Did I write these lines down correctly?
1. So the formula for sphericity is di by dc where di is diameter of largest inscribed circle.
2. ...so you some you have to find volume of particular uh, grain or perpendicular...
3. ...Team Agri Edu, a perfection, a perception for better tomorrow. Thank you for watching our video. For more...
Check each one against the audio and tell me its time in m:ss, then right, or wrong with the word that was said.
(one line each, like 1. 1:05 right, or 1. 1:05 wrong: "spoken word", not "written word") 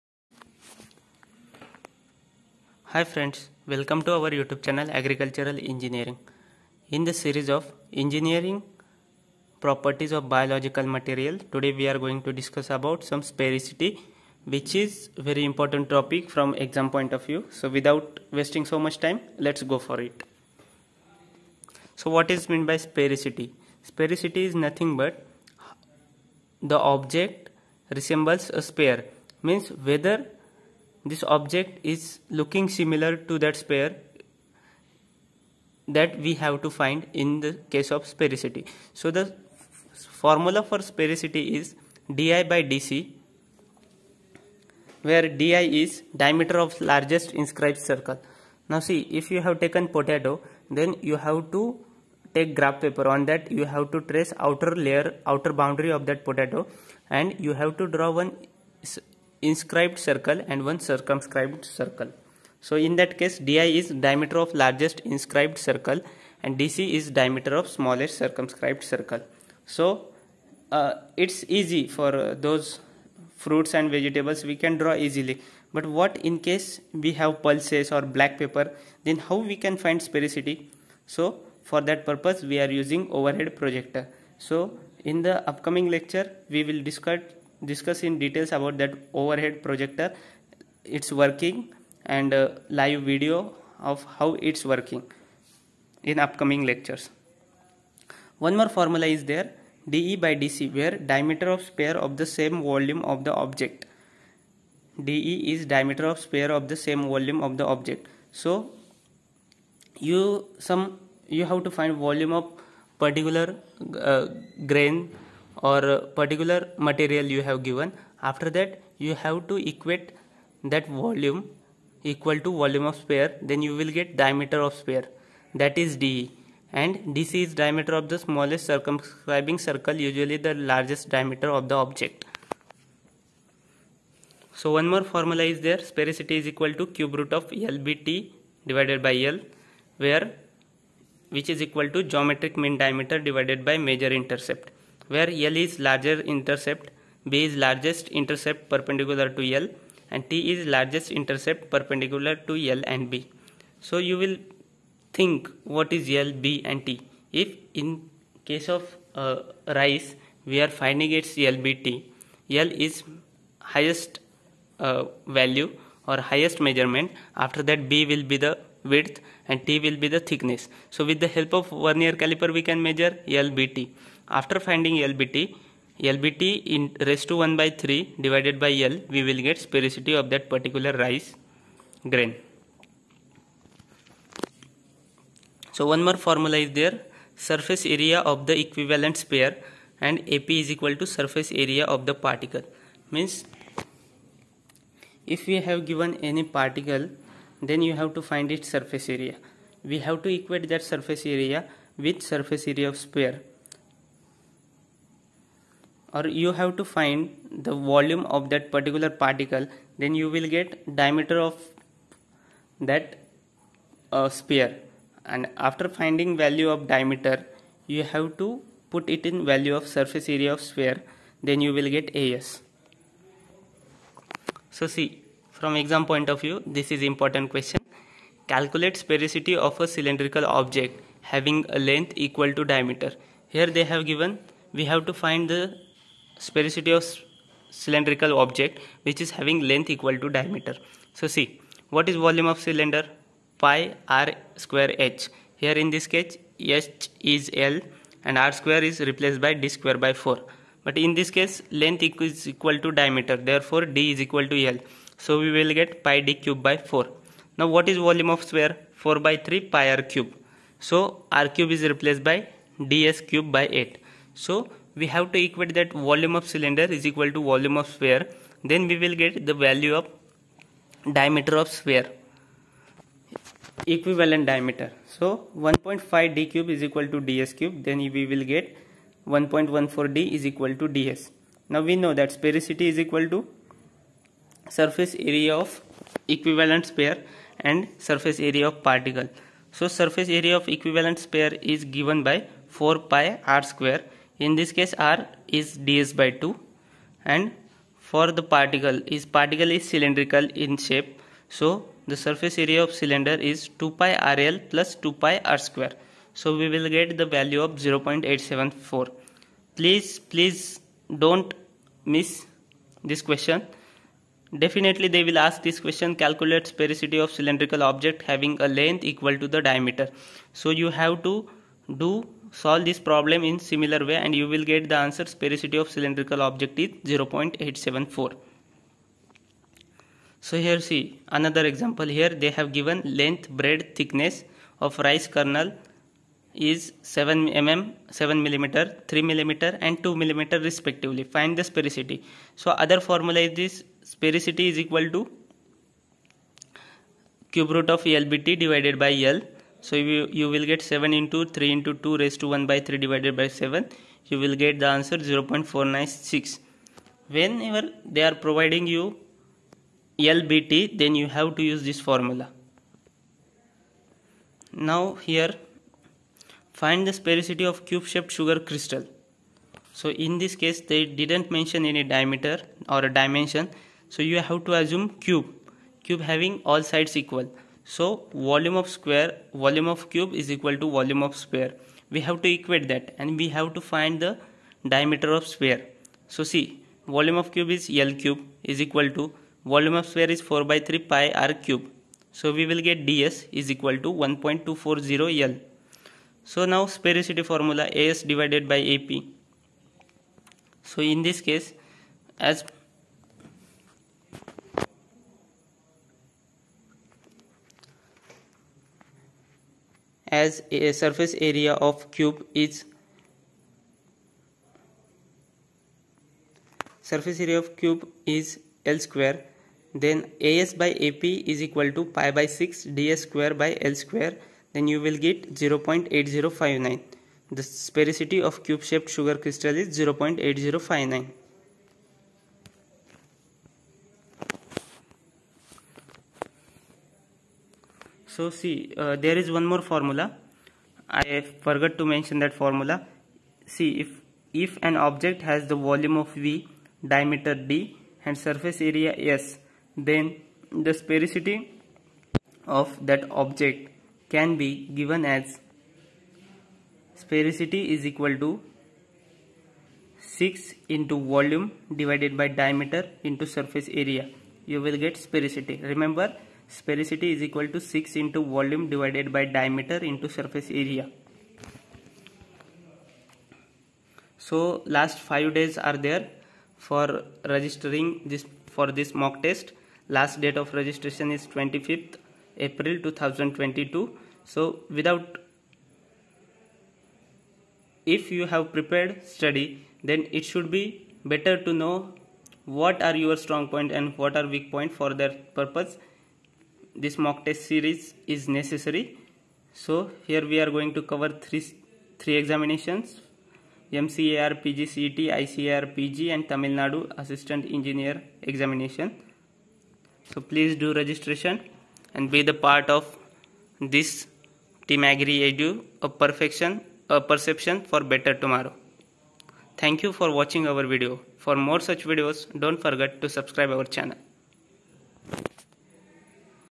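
1. 0:38 right
2. 1:48 wrong: "particular", not "perpendicular"
3. 8:34 right.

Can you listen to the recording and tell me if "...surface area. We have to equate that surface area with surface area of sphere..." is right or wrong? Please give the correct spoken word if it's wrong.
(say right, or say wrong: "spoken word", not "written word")
right.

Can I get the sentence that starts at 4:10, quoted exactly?
But in this case, length is equal to diameter.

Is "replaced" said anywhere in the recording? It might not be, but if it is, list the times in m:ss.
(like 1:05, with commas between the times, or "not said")
4:09, 4:21.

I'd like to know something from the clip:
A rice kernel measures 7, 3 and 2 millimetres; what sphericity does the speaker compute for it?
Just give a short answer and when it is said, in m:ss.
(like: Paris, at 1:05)
0.496, at 5:55.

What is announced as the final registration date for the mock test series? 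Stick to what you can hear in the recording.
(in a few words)
25 April 2022.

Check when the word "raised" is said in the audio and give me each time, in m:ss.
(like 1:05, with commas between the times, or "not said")
2:57, 5:52.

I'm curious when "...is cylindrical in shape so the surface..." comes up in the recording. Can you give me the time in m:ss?
4:59.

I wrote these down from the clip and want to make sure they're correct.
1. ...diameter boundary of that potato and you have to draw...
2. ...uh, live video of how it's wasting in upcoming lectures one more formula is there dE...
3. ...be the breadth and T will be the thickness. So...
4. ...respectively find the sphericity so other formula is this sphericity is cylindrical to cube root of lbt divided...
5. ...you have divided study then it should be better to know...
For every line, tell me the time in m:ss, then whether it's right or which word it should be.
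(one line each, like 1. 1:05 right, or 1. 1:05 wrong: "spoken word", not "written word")
1. 0:55 wrong: "outer", not "diameter"
2. 1:32 wrong: "working", not "wasting"
3. 2:48 wrong: "width", not "breadth"
4. 5:40 wrong: "equal", not "cylindrical"
5. 8:08 wrong: "prepared", not "divided".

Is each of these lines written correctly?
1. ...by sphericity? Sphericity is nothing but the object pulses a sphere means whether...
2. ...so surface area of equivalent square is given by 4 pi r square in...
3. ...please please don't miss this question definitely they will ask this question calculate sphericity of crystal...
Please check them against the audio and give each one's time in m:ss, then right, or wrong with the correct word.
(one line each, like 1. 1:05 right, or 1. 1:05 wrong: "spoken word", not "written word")
1. 0:22 wrong: "resembles", not "pulses"
2. 4:49 wrong: "sphere", not "square"
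3. 5:09 wrong: "cylindrical", not "crystal".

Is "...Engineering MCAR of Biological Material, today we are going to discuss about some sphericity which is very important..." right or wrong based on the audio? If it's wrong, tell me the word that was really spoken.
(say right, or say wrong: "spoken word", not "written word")
wrong: "Properties", not "MCAR".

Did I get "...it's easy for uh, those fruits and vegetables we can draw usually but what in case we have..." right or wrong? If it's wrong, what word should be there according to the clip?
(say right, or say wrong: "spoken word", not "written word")
wrong: "easily", not "usually".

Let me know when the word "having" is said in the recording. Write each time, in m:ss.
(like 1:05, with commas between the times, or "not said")
3:51, 3:59, 5:18, 6:16.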